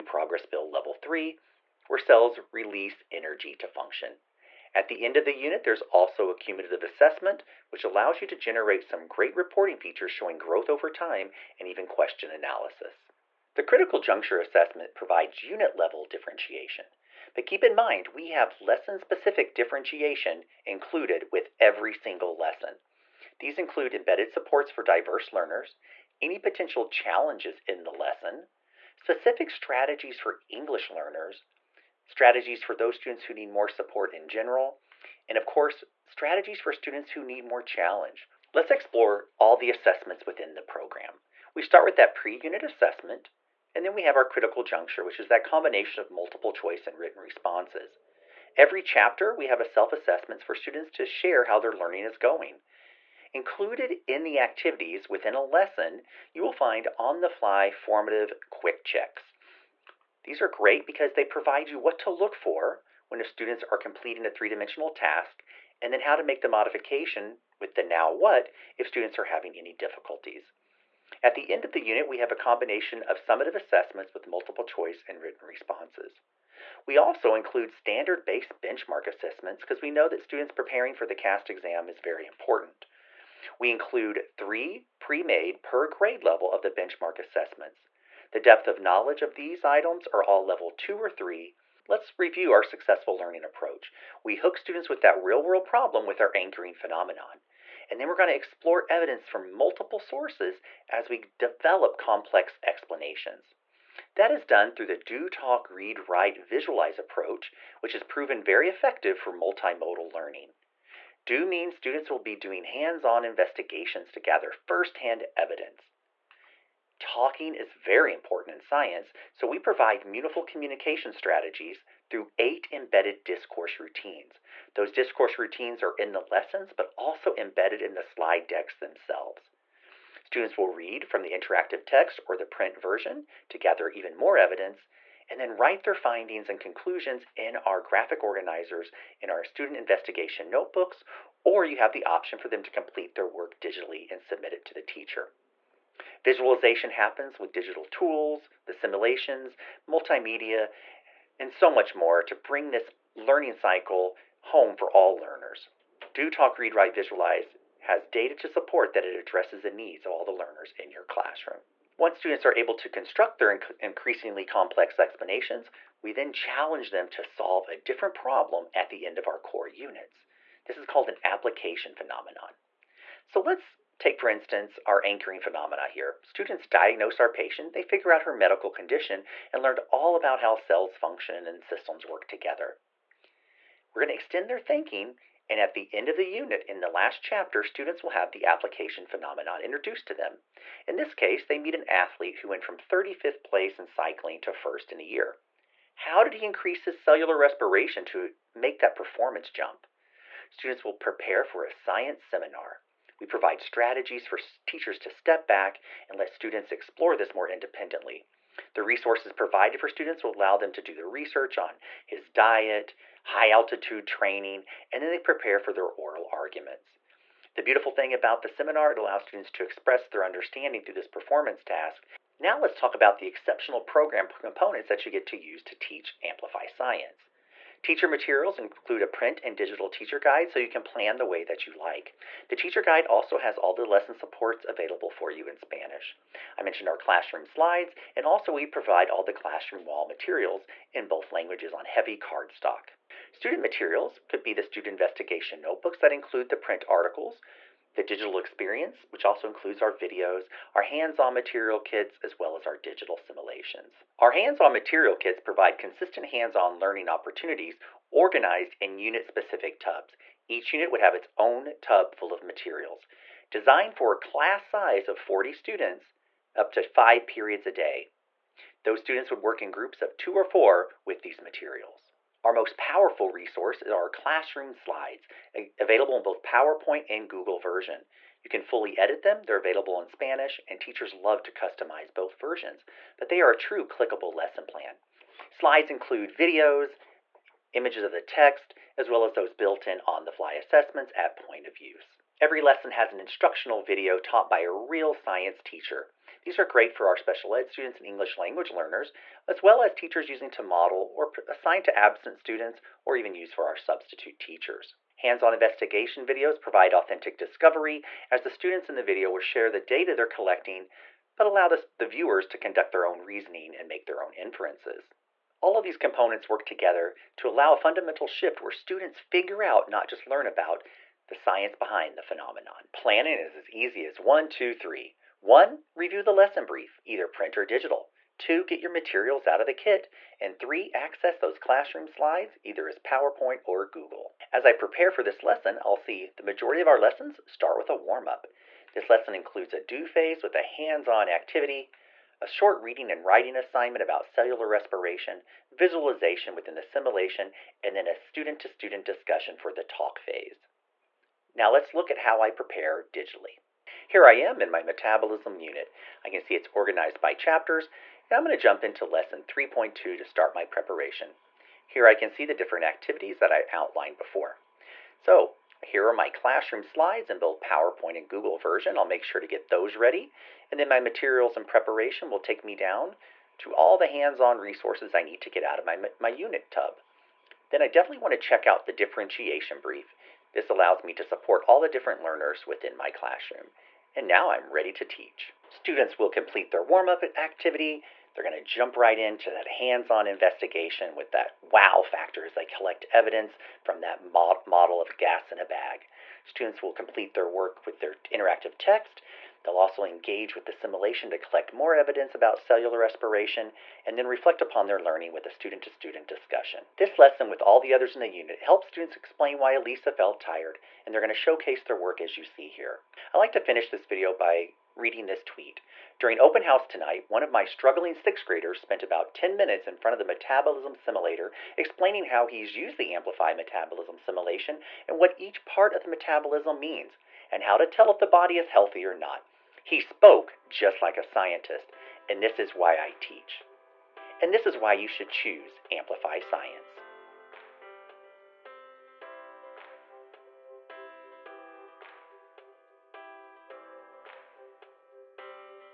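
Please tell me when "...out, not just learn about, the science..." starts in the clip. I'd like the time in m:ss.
5:19.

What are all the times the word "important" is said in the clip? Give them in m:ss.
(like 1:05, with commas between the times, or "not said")
1:22, 1:58.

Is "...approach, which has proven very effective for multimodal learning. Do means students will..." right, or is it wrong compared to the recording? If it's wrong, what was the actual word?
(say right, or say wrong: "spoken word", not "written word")
right.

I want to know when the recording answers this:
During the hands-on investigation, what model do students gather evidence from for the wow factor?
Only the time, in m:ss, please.
6:35.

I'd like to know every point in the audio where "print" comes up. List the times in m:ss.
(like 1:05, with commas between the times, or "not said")
2:12, 3:49, 4:06, 5:27.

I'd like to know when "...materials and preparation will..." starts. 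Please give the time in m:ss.
6:10.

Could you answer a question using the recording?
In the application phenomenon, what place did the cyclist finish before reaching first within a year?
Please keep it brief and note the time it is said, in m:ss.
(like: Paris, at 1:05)
35th, at 3:12.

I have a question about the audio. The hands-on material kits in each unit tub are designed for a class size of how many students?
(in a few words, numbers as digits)
40.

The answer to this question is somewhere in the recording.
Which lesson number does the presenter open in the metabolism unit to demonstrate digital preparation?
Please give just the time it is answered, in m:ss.
5:59.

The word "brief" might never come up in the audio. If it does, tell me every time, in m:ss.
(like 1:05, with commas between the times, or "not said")
5:26, 6:19.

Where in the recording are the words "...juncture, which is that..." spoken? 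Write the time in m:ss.
0:44.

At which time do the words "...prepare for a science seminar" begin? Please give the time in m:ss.
3:20.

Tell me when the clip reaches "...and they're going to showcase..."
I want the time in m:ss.
6:51.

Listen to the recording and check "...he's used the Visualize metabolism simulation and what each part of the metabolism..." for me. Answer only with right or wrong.
wrong.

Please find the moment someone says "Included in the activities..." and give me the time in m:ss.
0:53.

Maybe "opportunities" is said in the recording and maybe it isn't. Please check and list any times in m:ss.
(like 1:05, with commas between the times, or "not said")
4:17.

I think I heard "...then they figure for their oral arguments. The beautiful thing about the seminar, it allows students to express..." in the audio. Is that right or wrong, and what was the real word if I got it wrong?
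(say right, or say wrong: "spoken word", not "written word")
wrong: "prepare", not "figure".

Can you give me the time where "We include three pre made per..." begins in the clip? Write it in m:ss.
1:23.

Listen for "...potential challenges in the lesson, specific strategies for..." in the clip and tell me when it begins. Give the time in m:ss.
0:26.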